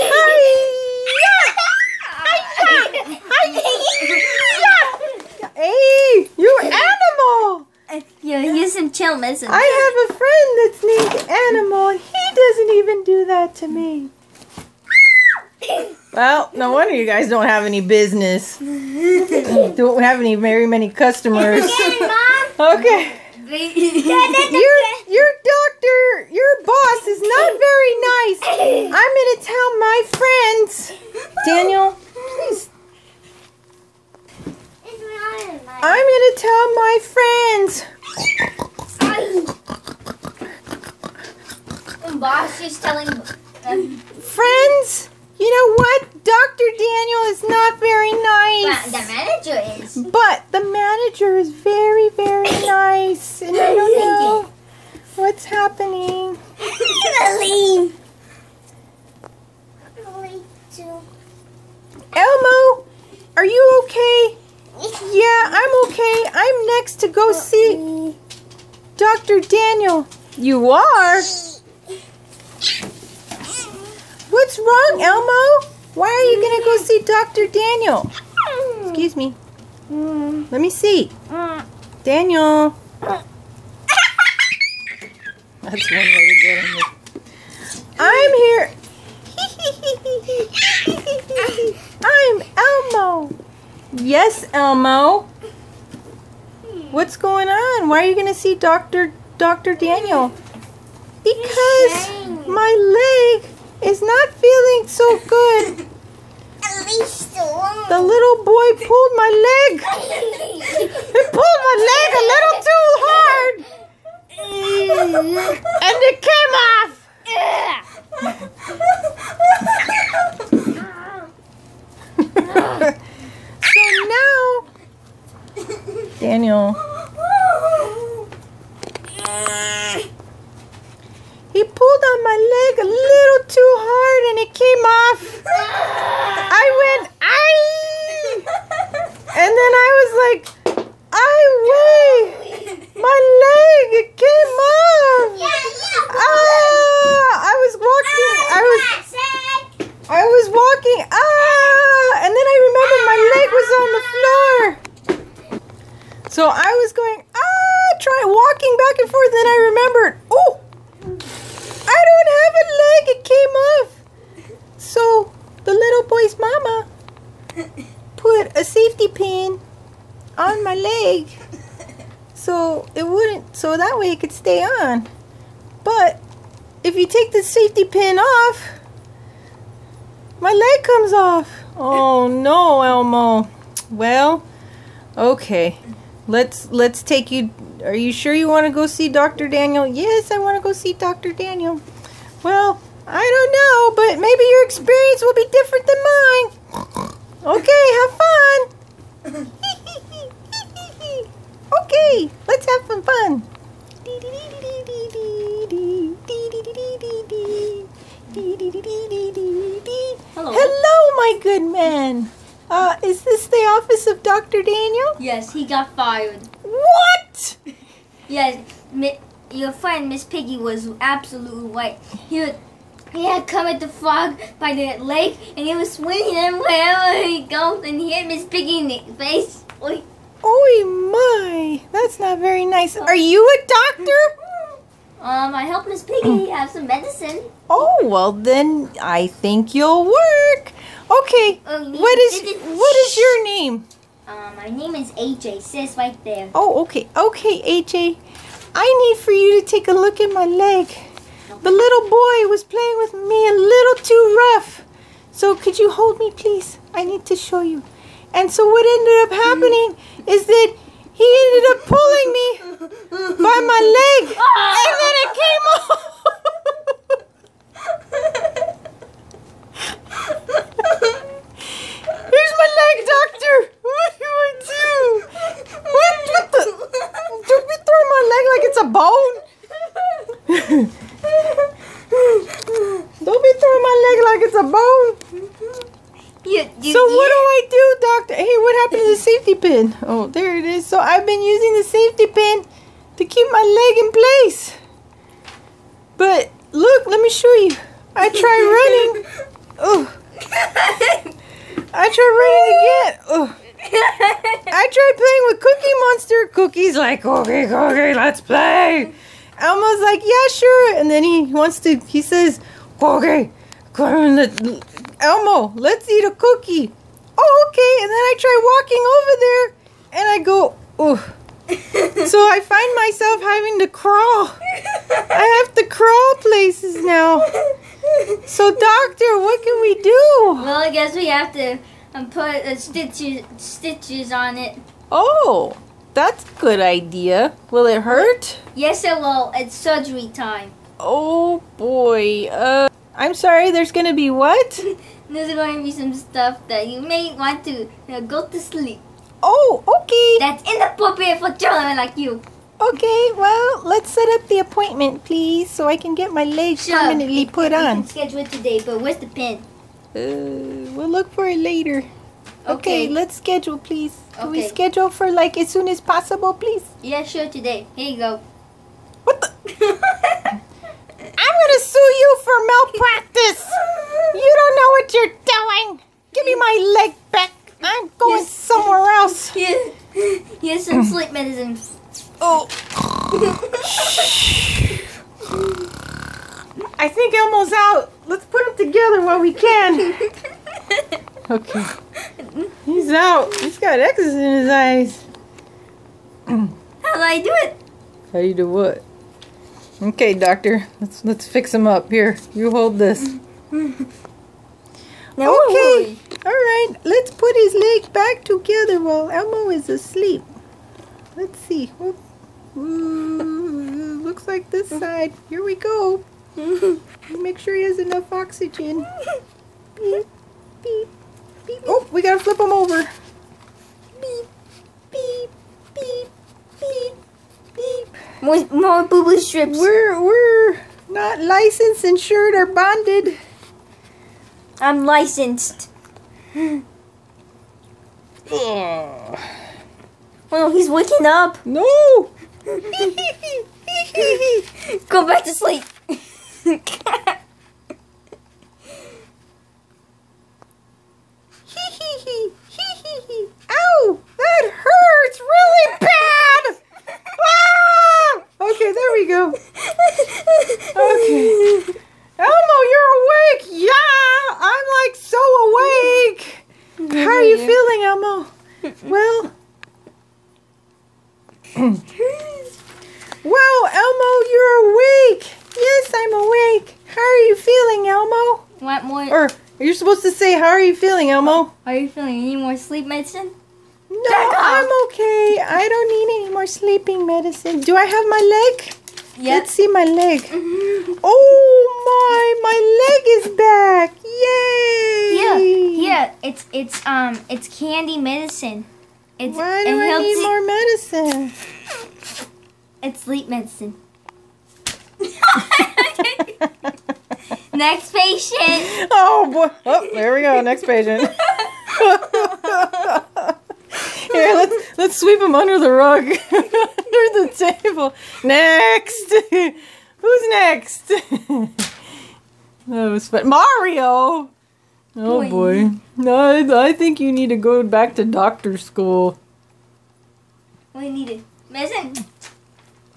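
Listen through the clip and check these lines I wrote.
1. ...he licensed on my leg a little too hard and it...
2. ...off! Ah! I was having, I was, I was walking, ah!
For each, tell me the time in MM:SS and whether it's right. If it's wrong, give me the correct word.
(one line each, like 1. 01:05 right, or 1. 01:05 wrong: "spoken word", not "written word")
1. 02:11 wrong: "pulled", not "licensed"
2. 02:24 wrong: "walking", not "having".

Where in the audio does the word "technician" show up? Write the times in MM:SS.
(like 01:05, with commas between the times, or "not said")
not said.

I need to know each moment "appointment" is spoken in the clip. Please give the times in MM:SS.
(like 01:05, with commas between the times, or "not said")
05:54.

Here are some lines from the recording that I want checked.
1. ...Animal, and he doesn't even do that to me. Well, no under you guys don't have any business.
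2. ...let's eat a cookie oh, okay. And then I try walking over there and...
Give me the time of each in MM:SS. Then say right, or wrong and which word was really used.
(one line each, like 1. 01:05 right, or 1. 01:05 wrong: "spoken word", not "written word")
1. 00:11 wrong: "wonder", not "under"
2. 05:15 right.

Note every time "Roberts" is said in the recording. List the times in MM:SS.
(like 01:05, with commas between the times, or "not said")
not said.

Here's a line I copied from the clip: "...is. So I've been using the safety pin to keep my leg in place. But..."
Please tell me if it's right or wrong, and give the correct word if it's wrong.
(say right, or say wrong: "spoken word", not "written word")
right.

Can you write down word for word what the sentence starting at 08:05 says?
I don't need any more sleeping medicine.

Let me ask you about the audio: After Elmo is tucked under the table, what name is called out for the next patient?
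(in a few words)
Mario.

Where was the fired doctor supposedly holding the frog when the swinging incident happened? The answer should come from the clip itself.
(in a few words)
By the lake.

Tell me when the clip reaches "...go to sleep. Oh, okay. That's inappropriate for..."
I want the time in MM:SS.
05:48.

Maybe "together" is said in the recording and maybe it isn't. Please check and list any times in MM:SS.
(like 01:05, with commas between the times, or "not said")
06:28, 06:48.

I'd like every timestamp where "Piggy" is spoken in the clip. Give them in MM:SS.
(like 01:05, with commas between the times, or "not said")
03:40, 03:48, 03:56.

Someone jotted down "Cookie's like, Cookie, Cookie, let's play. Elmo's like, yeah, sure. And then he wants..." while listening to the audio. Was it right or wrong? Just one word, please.
right.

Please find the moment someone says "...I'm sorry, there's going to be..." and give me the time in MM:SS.
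05:43.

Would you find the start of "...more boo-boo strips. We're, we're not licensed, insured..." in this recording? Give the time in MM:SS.
07:08.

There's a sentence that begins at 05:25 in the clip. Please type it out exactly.
I have to crawl places now.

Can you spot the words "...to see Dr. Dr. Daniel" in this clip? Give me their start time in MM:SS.
01:38.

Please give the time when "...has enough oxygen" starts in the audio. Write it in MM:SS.
06:57.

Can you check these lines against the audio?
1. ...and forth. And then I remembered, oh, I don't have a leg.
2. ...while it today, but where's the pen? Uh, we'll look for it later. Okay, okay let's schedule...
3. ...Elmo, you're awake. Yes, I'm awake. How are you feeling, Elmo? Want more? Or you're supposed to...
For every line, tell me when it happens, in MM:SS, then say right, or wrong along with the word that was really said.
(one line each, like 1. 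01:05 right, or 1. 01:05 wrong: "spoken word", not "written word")
1. 02:39 right
2. 05:58 wrong: "schedule", not "while"
3. 07:53 right.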